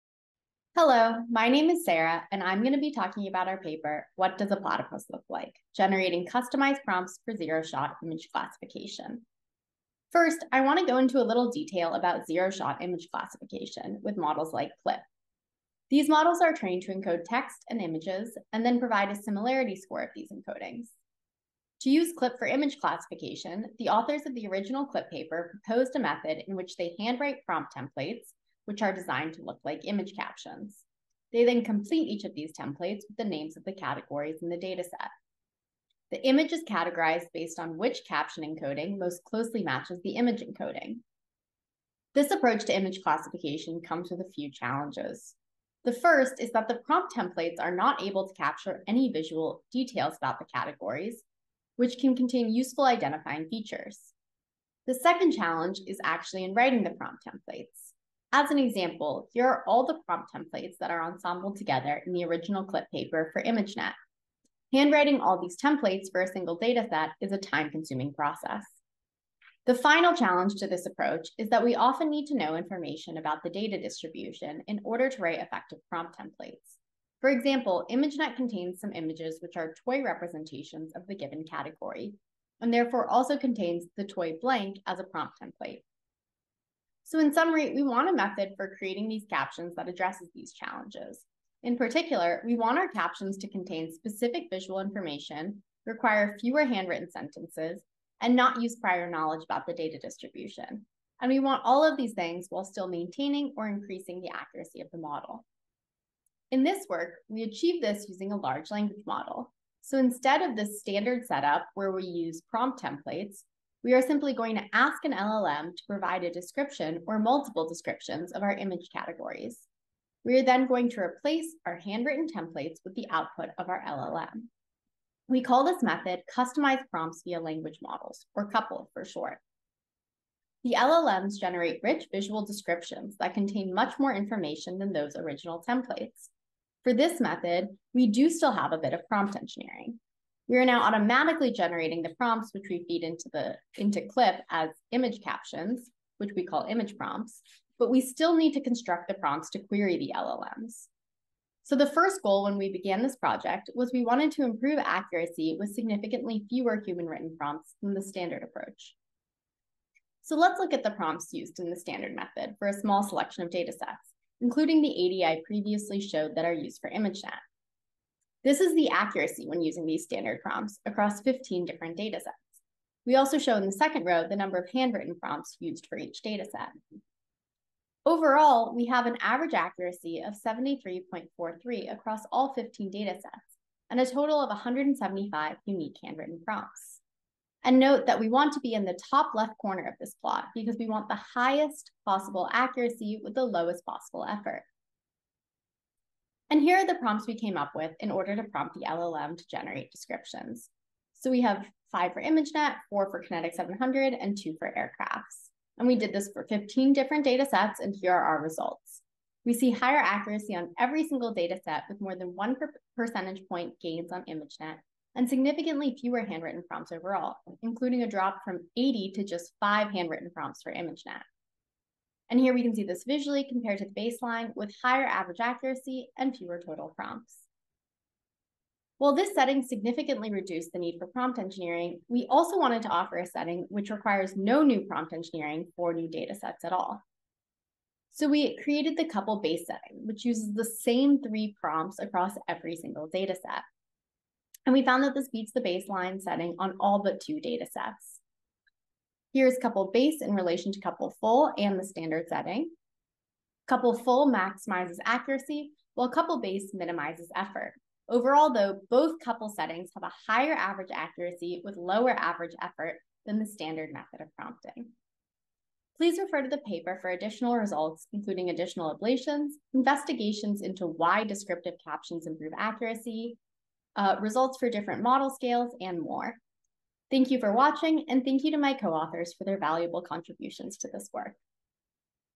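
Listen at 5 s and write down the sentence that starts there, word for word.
Generating Customized Prompts for Zero Shot Image Classification.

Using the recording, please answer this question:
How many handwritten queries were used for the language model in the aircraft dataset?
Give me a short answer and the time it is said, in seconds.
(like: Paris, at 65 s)
2, at 204 s.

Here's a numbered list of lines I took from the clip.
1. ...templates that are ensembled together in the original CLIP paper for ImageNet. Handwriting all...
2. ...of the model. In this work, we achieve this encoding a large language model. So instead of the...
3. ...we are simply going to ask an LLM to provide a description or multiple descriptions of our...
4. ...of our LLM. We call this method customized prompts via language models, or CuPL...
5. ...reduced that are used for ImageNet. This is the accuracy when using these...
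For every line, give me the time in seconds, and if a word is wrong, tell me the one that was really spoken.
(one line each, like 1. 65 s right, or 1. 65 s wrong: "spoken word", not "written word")
1. 60 s right
2. 104 s wrong: "using", not "encoding"
3. 113 s right
4. 123 s right
5. 166 s wrong: "showed", not "reduced".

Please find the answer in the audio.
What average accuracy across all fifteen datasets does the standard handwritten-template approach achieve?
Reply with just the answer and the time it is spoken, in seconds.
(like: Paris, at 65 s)
73.43, at 180 s.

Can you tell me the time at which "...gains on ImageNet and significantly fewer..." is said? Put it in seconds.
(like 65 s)
213 s.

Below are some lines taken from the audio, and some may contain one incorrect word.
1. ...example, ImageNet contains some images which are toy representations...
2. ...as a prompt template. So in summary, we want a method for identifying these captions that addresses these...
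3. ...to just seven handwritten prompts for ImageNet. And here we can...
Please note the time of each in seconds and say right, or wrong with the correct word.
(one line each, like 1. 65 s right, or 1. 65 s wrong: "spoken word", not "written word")
1. 77 s right
2. 84 s wrong: "creating", not "identifying"
3. 219 s wrong: "five", not "seven".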